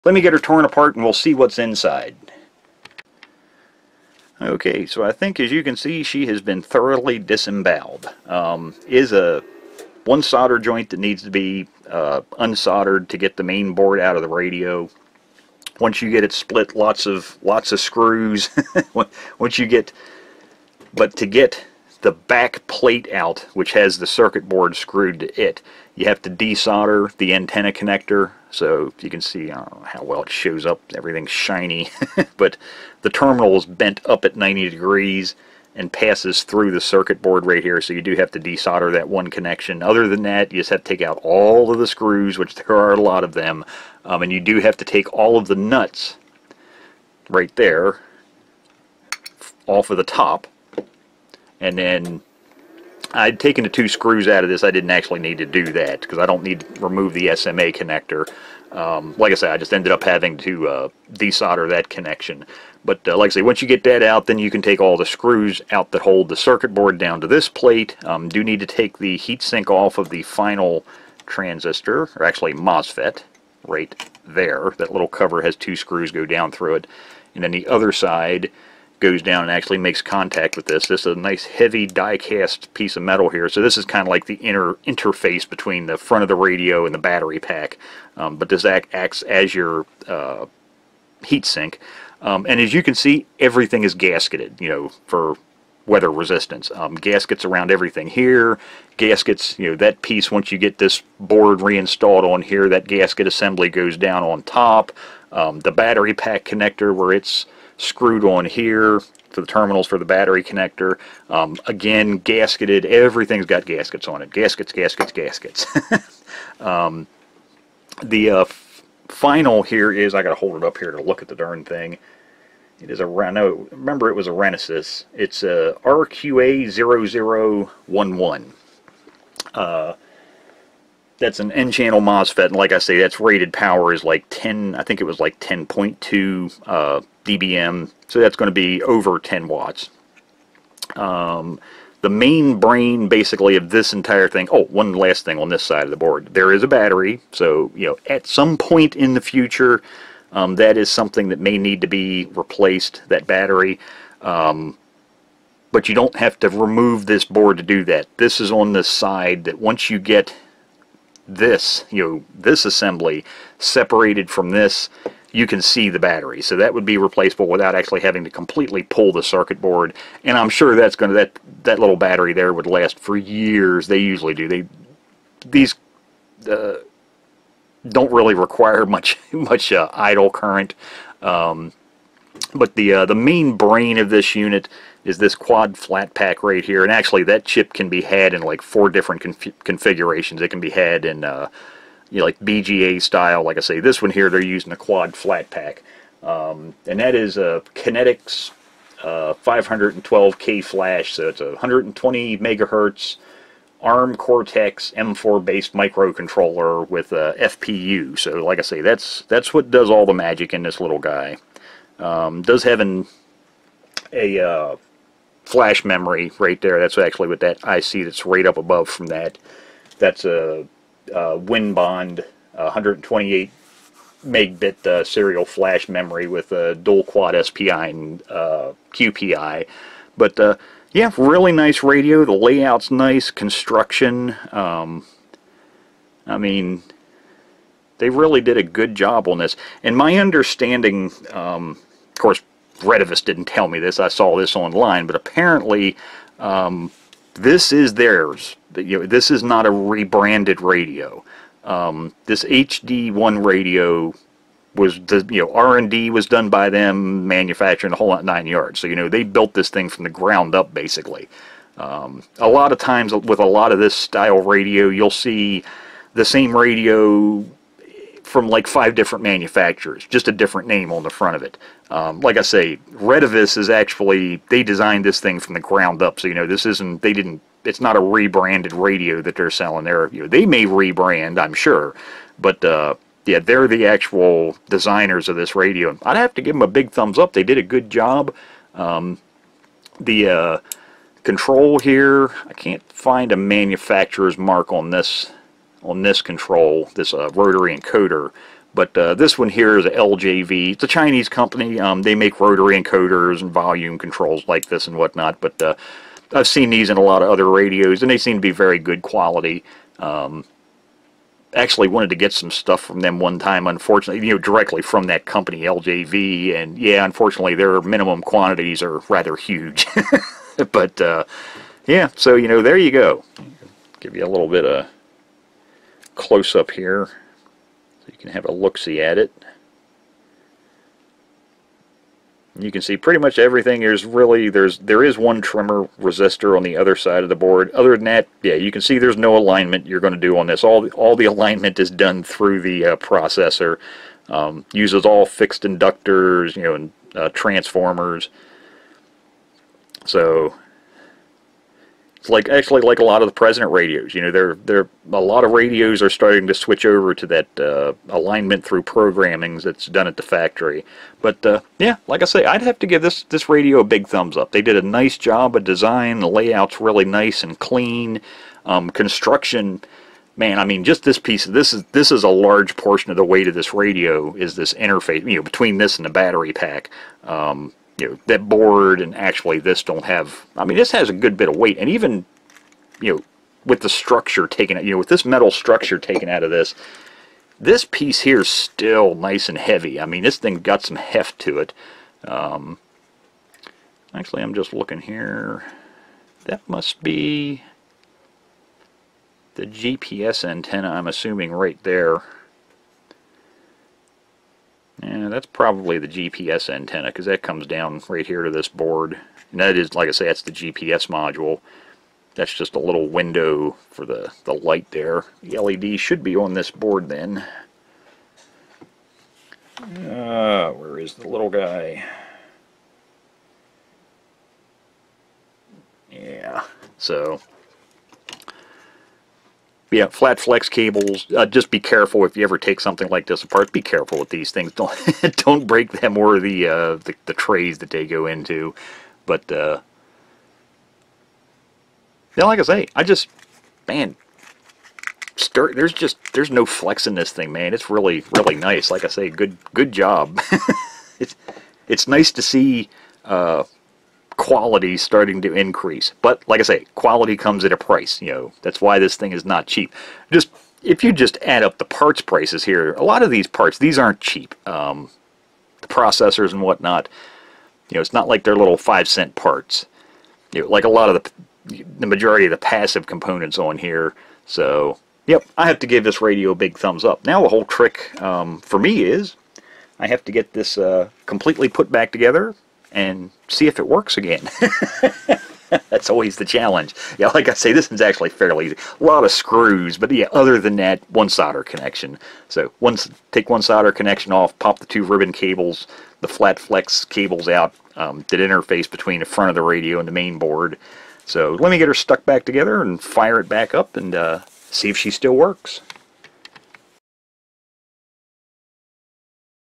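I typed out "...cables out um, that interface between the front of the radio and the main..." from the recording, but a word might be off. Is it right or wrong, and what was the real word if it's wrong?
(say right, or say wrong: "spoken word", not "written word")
right.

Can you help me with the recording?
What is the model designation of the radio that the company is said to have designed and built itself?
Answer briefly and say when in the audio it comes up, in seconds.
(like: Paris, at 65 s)
HD1, at 252 s.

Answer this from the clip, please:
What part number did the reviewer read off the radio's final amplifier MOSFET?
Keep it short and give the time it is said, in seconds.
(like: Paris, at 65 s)
RQA0011, at 125 s.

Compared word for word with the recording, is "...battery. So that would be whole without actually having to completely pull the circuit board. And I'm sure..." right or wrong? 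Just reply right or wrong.
wrong.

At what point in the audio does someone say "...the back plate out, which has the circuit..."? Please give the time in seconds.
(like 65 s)
22 s.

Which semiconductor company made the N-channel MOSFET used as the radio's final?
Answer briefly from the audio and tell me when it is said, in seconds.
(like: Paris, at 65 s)
Renesas, at 124 s.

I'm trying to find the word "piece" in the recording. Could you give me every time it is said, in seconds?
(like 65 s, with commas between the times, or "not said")
82 s, 100 s, 371 s, 387 s.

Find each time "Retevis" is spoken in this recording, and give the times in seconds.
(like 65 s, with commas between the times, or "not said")
242 s, 272 s.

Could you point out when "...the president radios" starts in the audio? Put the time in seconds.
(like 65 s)
353 s.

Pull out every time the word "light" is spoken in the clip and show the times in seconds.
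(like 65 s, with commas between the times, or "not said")
414 s.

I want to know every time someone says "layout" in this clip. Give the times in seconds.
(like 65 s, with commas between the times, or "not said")
232 s, 366 s.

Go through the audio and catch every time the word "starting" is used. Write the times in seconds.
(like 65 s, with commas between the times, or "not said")
356 s, 454 s.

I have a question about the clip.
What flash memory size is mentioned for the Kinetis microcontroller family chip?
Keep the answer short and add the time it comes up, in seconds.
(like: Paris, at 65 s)
512K, at 199 s.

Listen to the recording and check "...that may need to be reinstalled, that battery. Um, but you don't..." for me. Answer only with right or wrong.
wrong.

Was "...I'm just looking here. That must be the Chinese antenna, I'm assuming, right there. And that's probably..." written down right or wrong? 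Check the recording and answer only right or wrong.
wrong.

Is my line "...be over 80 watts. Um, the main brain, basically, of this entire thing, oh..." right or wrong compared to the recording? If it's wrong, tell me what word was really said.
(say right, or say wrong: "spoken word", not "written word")
wrong: "10", not "80".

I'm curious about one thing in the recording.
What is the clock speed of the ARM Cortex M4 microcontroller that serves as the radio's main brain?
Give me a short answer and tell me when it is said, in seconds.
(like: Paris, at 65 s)
120 megahertz, at 201 s.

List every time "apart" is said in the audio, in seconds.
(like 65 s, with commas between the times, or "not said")
0 s, 433 s.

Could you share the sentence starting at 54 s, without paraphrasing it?
I didn't actually need to do that because I don't need to remove the SMA connector.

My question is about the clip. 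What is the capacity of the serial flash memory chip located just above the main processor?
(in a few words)
128 megabit.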